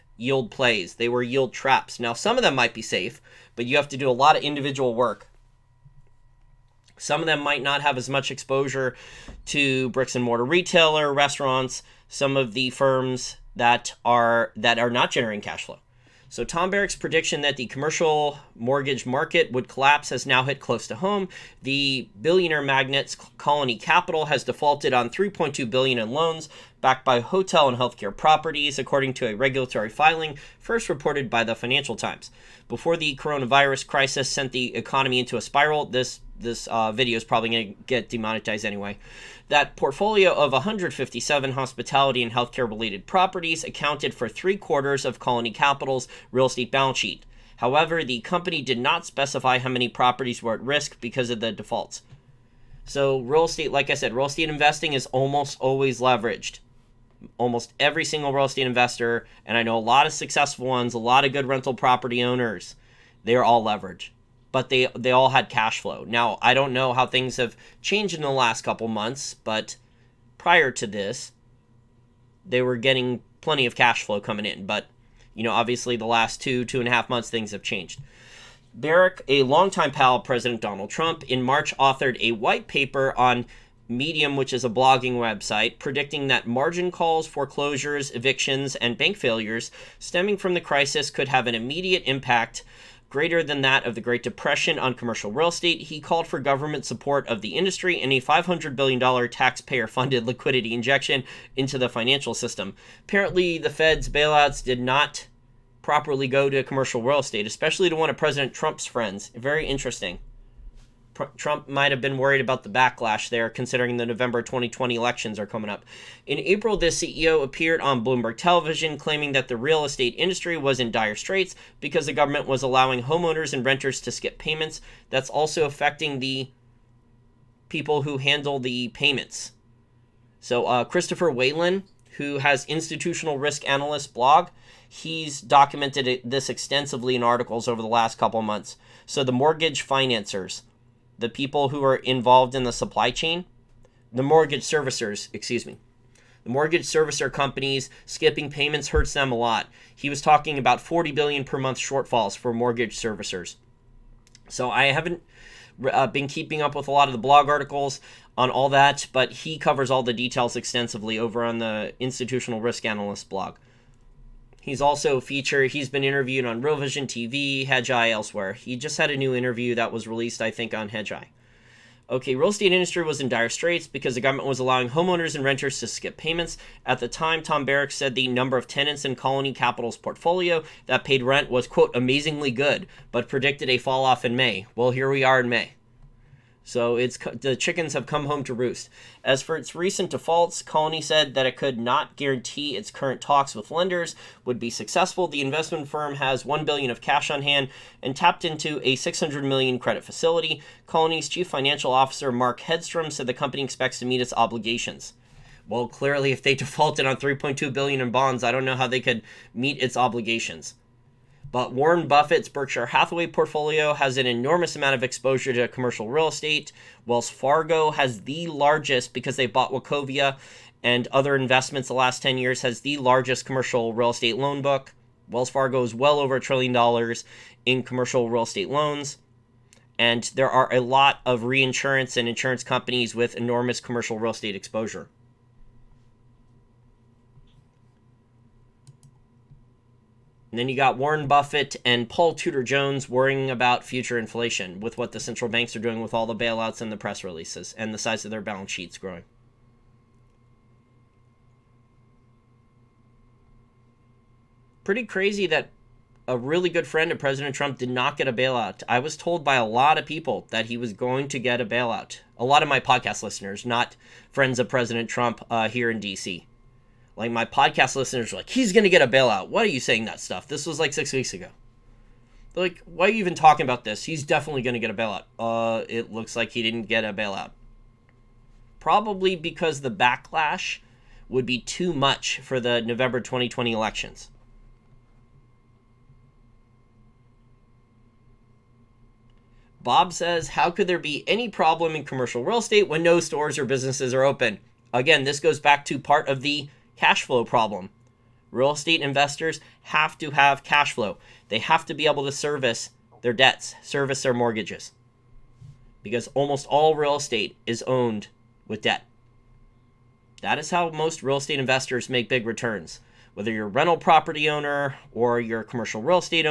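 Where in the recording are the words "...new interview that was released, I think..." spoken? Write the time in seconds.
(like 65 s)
169 s.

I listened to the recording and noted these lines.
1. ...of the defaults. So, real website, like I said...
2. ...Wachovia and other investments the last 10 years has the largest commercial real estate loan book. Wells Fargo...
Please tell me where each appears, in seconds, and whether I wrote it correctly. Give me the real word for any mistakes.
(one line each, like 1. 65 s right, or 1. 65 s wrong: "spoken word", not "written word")
1. 51 s wrong: "estate", not "website"
2. 219 s right.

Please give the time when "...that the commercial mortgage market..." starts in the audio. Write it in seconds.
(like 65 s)
17 s.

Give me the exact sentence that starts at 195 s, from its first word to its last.
The investment firm has 1 billion of cash on hand and tapped into a 600 million credit facility.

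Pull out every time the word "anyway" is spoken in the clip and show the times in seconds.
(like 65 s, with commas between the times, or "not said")
38 s.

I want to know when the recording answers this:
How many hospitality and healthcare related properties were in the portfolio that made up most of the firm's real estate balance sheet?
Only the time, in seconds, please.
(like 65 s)
40 s.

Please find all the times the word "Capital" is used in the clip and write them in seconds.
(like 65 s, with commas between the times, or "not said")
23 s, 45 s, 179 s.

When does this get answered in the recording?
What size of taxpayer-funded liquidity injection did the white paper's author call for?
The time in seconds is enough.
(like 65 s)
98 s.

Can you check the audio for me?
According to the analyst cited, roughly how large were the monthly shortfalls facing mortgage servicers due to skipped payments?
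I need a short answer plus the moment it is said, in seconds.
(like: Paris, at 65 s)
$40 billion, at 150 s.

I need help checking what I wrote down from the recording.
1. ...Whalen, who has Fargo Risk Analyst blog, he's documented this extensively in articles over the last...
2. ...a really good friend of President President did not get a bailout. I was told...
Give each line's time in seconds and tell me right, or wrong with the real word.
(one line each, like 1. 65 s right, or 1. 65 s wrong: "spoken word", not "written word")
1. 131 s wrong: "Institutional", not "Fargo"
2. 256 s wrong: "Trump", not "President".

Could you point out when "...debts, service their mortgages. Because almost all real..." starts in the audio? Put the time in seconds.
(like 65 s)
303 s.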